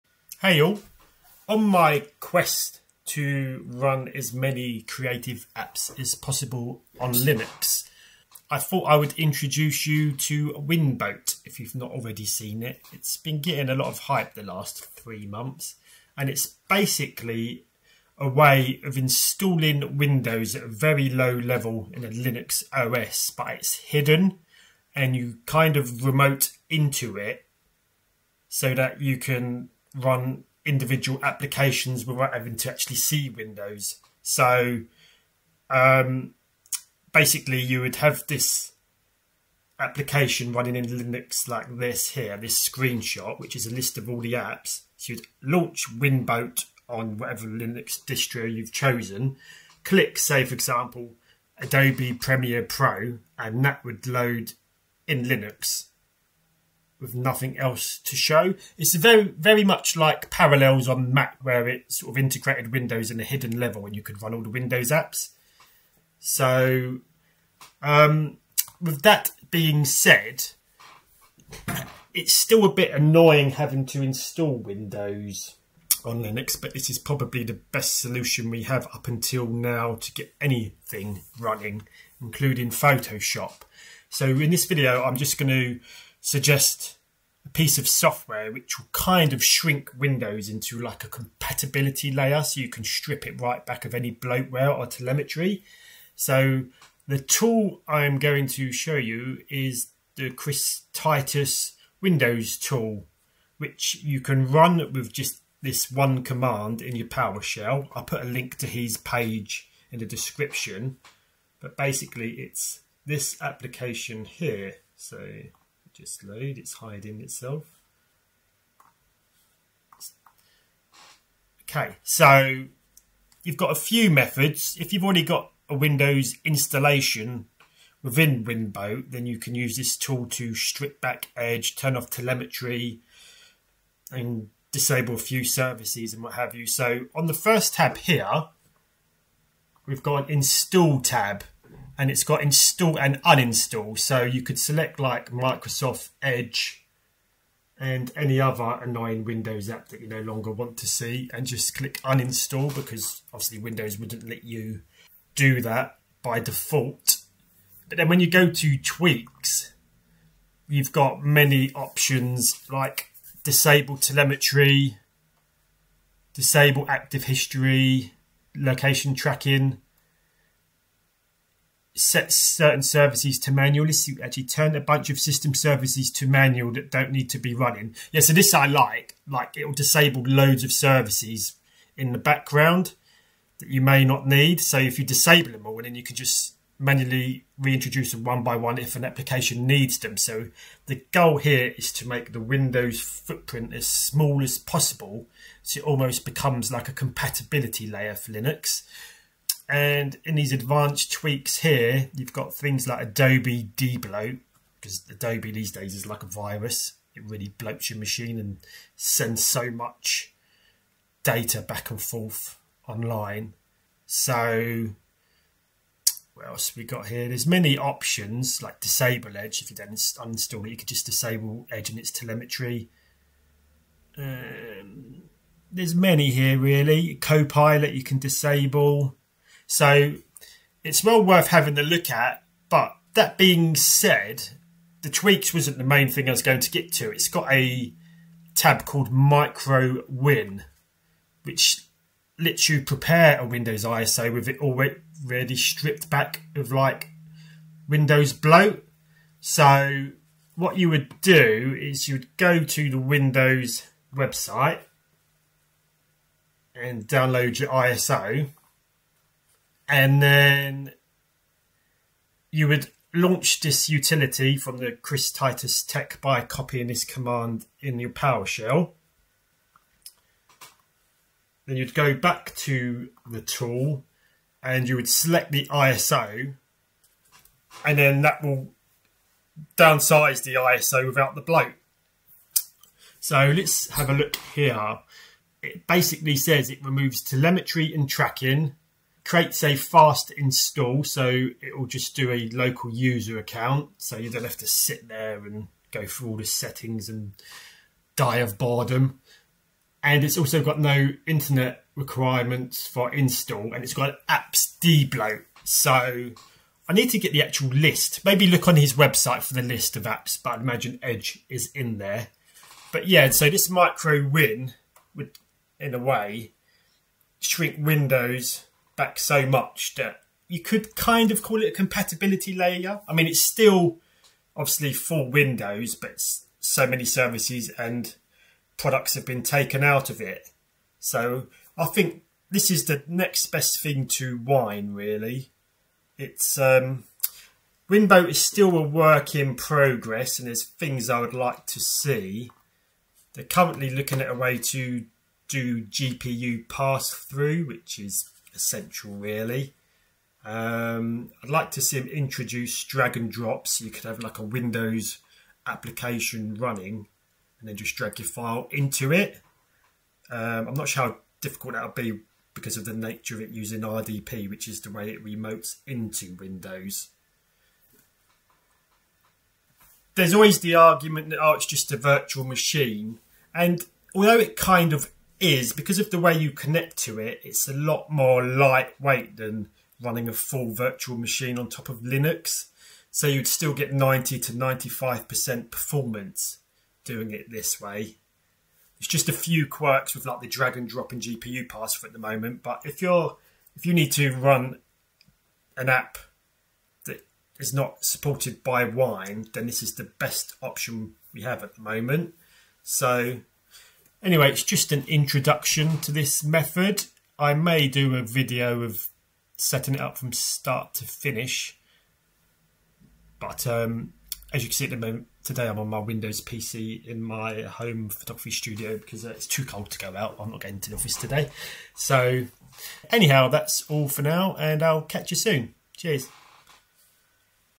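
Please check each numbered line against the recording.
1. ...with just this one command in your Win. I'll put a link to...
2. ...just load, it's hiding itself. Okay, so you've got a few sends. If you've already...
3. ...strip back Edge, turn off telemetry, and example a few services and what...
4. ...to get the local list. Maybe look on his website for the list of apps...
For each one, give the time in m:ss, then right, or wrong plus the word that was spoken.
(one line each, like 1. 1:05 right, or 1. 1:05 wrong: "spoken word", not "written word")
1. 1:44 wrong: "PowerShell", not "Win"
2. 1:55 wrong: "methods", not "sends"
3. 2:10 wrong: "disable", not "example"
4. 5:07 wrong: "actual", not "local".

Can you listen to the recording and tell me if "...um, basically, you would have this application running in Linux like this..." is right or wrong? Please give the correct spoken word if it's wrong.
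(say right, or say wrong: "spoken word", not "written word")
right.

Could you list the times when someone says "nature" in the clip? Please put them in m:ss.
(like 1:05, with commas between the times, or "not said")
6:02.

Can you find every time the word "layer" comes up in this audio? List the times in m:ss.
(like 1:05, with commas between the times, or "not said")
1:32, 3:17, 5:22.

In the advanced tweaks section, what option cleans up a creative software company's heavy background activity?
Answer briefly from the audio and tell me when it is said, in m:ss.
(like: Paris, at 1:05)
Adobe debloat, at 3:23.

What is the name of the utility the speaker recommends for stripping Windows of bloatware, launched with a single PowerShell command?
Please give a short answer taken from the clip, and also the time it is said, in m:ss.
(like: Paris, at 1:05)
Chris Titus Windows tool, at 1:40.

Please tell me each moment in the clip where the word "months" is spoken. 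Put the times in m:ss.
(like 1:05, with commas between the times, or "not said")
0:15.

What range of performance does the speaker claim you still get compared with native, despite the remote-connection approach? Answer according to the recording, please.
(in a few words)
90 to 95%.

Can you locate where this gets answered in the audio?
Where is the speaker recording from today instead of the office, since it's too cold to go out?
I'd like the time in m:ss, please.
6:57.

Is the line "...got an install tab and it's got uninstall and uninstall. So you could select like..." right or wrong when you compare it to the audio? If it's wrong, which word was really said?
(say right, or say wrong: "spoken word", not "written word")
wrong: "install", not "uninstall".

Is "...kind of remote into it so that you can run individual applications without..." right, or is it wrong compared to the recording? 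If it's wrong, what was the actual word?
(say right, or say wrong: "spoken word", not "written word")
right.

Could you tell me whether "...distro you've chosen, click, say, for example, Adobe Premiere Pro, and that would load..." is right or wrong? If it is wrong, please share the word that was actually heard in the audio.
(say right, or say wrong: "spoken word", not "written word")
right.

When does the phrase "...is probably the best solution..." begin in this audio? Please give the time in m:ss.
1:16.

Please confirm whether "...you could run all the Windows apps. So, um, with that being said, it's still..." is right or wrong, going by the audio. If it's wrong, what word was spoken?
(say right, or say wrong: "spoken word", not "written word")
right.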